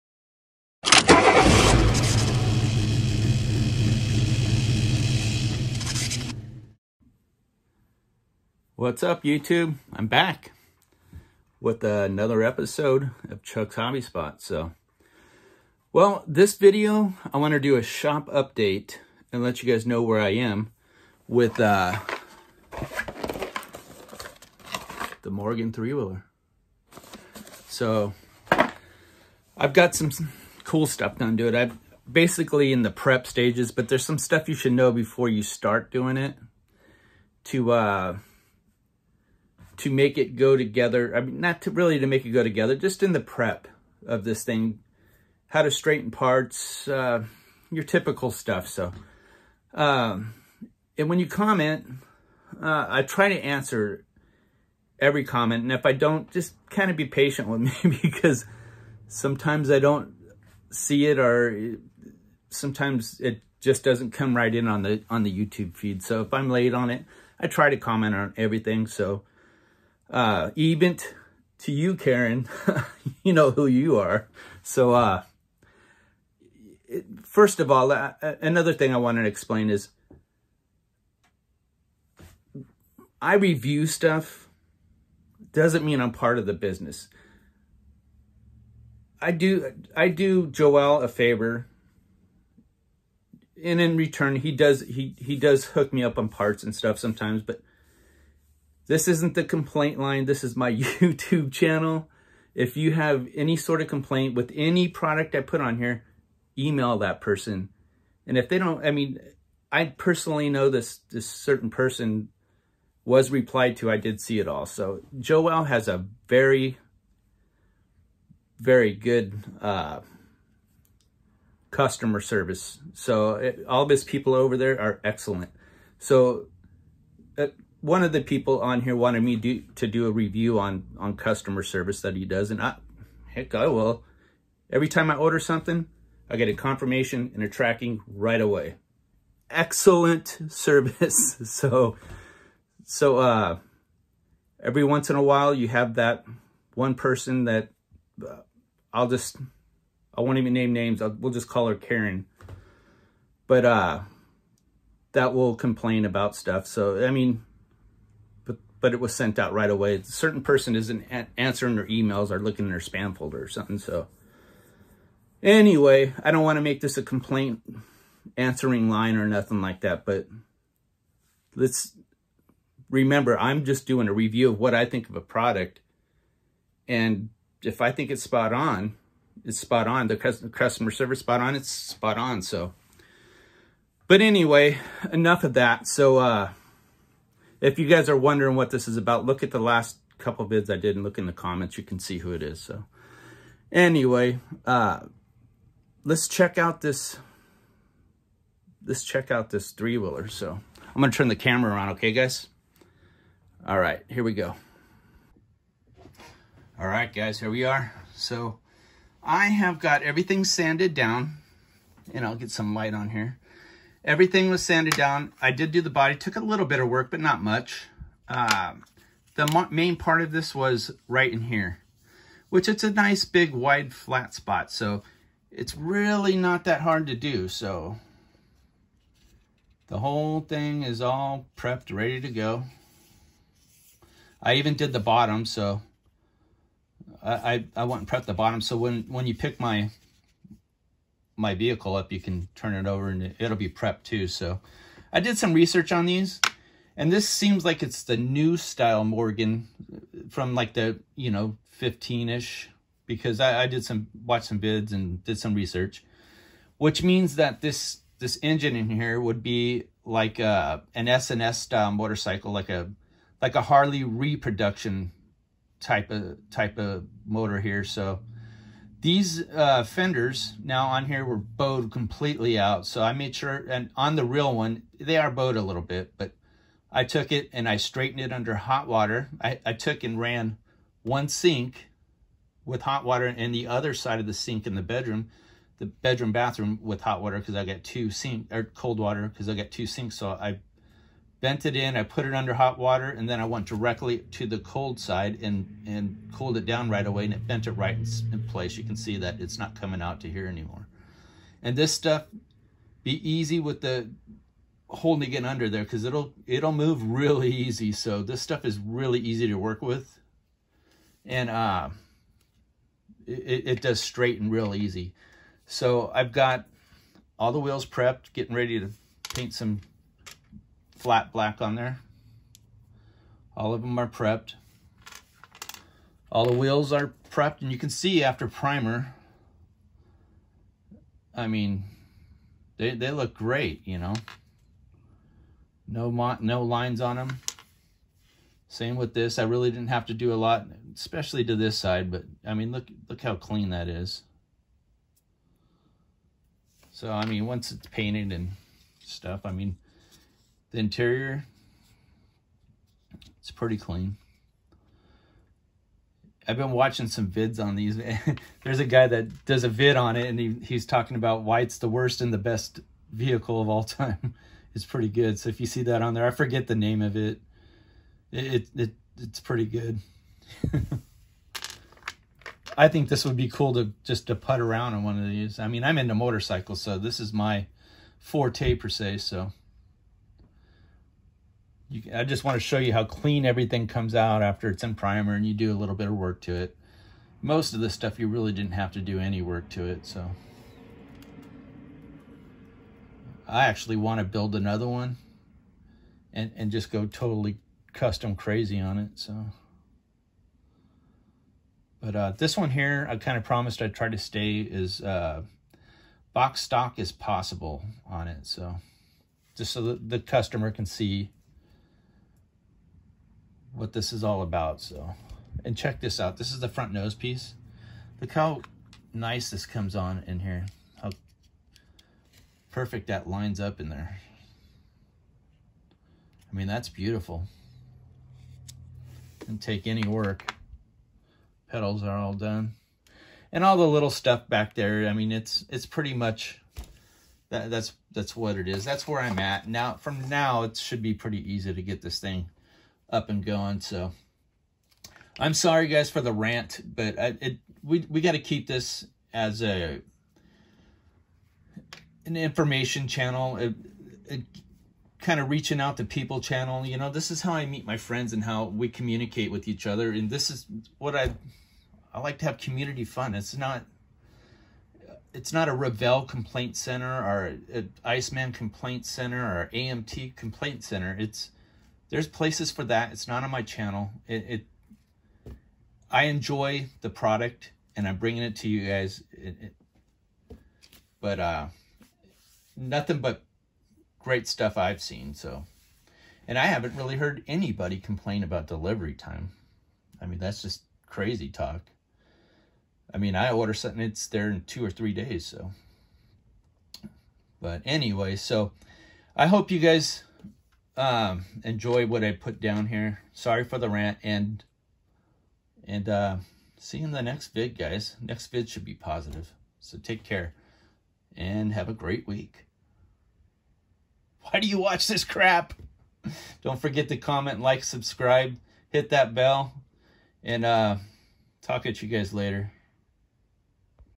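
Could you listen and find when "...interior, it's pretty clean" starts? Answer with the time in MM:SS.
05:50.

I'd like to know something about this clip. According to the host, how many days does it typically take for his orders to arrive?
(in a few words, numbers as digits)
2 or 3 days.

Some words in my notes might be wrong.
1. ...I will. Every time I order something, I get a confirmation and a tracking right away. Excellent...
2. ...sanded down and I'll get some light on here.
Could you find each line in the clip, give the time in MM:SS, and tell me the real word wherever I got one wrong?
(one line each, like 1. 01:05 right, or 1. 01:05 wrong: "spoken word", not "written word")
1. 02:13 right
2. 03:30 right.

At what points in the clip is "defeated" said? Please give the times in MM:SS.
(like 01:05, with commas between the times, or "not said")
not said.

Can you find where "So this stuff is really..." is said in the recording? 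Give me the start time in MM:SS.
05:07.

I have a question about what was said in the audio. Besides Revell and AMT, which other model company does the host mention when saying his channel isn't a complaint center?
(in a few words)
Iceman.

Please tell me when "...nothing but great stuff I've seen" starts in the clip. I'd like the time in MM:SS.
08:02.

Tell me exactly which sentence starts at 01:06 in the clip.
So if I'm late on it, I try to comment on everything.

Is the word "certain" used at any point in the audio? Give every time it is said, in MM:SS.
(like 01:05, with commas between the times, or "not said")
01:51, 02:40.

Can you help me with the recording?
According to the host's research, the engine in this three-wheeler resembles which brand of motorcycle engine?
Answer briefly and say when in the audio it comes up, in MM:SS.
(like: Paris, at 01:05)
S&S, at 04:21.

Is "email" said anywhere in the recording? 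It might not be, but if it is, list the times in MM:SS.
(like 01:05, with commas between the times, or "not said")
01:46, 02:41.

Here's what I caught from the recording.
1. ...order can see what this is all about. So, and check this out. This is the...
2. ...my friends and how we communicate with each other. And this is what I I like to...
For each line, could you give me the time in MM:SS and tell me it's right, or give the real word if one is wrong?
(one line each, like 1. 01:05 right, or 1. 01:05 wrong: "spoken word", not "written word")
1. 06:50 wrong: "customer", not "order"
2. 07:37 right.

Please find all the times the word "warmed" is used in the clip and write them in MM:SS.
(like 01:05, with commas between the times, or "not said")
not said.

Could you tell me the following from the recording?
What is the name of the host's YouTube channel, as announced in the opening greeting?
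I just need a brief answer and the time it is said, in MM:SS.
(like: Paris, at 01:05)
Chuck's Hobby Spot, at 00:13.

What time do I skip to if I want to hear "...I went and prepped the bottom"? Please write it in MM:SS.
03:57.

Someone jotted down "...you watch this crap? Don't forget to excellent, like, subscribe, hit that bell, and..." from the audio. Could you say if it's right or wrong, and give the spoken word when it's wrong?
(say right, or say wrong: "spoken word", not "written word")
wrong: "comment", not "excellent".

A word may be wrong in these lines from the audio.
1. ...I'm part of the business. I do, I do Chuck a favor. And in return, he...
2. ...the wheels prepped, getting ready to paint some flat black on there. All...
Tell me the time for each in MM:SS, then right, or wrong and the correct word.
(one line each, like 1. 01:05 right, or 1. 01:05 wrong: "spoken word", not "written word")
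1. 01:26 wrong: "Joel", not "Chuck"
2. 05:17 right.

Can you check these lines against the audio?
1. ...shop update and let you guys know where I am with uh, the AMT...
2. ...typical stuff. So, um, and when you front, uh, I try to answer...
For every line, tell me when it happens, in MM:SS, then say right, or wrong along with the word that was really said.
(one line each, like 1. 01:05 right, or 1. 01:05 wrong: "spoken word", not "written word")
1. 00:17 wrong: "Morgan", not "AMT"
2. 00:47 wrong: "comment", not "front".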